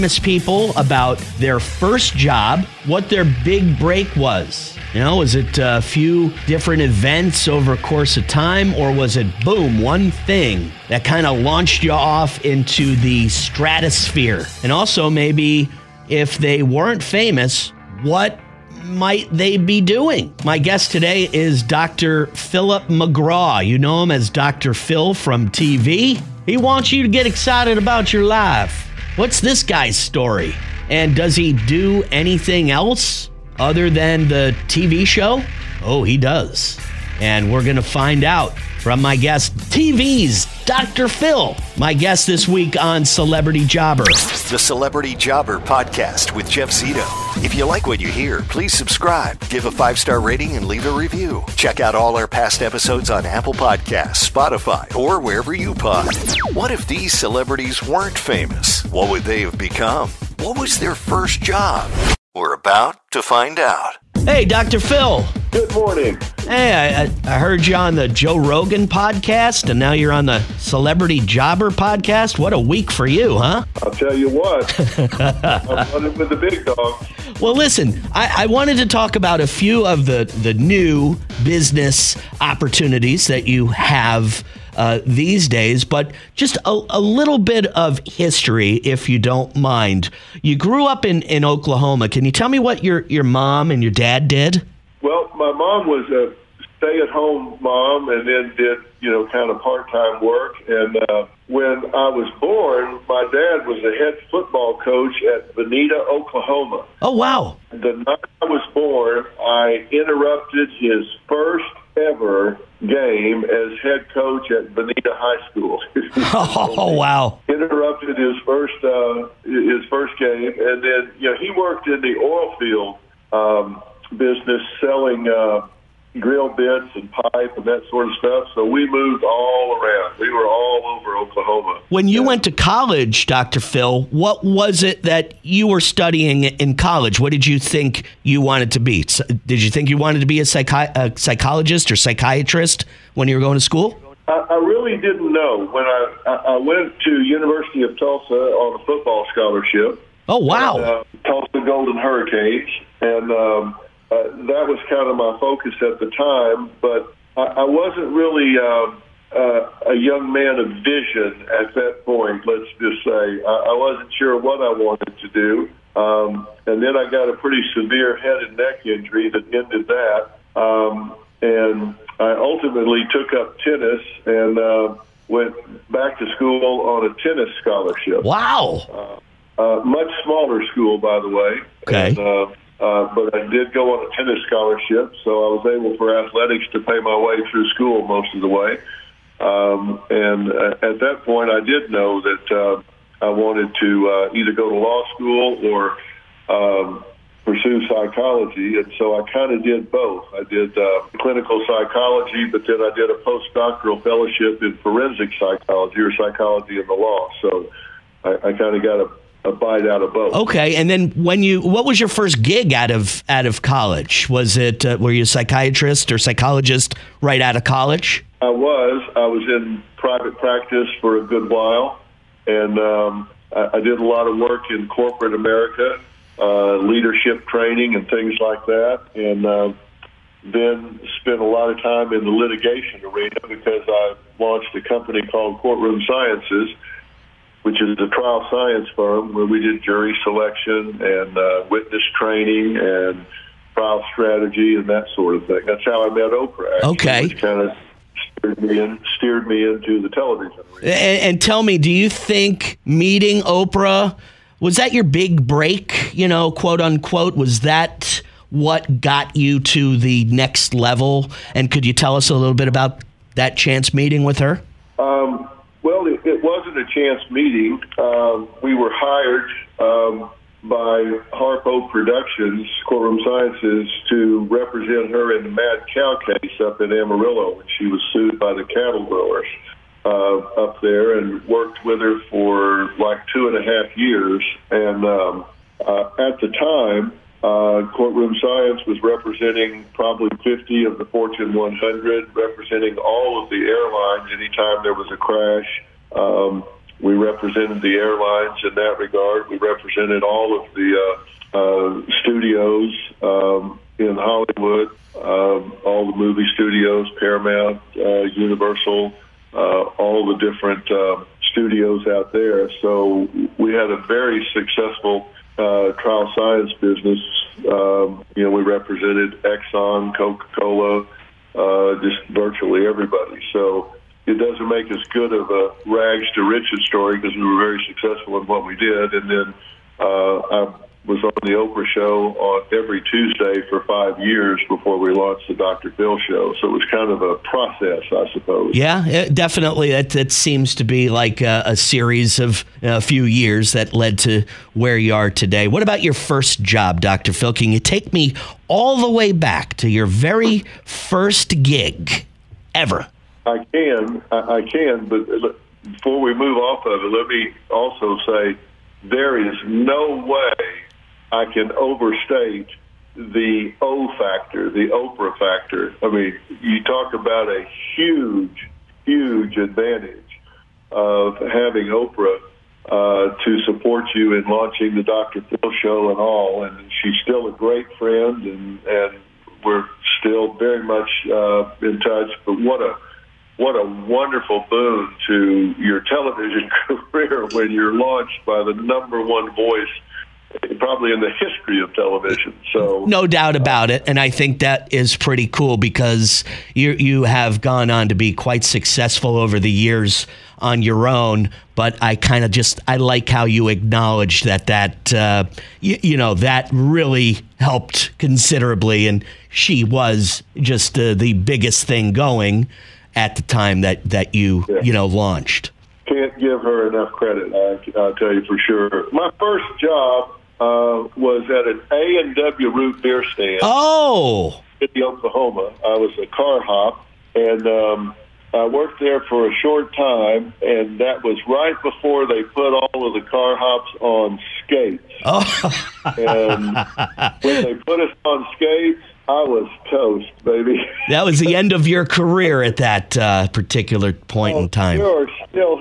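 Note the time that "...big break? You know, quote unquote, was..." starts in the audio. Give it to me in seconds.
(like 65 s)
255 s.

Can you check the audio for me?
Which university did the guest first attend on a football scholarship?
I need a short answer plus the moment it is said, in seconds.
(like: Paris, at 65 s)
University of Tulsa, at 147 s.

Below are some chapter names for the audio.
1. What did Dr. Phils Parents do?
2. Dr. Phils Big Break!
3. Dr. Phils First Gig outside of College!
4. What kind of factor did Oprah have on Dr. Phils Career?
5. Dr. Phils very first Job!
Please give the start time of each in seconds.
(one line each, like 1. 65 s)
1. 94 s
2. 256 s
3. 213 s
4. 358 s
5. 418 s.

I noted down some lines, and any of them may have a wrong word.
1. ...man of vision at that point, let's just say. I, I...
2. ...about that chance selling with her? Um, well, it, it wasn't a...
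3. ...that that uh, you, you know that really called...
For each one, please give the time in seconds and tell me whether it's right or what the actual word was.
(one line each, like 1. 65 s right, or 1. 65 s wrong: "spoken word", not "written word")
1. 160 s right
2. 262 s wrong: "meeting", not "selling"
3. 404 s wrong: "helped", not "called".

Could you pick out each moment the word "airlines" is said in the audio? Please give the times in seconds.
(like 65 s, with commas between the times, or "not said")
293 s, 297 s.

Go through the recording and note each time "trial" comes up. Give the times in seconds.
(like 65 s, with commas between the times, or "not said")
238 s, 243 s, 315 s.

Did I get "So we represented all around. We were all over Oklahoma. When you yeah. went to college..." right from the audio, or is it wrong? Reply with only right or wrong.
wrong.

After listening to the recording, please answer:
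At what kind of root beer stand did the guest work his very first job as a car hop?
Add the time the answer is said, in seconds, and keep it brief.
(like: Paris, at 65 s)
A and W, at 421 s.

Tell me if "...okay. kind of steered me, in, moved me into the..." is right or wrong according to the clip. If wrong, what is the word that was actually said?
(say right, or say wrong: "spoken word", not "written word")
wrong: "steered", not "moved".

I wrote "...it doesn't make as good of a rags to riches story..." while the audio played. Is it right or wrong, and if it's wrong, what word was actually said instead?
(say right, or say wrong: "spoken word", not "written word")
right.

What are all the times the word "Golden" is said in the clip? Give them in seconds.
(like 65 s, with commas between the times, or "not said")
151 s.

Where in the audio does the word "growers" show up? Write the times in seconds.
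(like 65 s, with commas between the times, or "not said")
279 s.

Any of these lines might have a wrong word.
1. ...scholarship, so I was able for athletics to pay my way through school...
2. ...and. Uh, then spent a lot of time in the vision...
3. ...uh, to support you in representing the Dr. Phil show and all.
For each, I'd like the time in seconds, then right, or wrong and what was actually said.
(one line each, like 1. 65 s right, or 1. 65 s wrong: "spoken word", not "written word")
1. 184 s right
2. 229 s wrong: "litigation", not "vision"
3. 372 s wrong: "launching", not "representing".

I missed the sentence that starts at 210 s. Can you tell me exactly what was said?
Okay, and then when you, what was your first gig out of out of college?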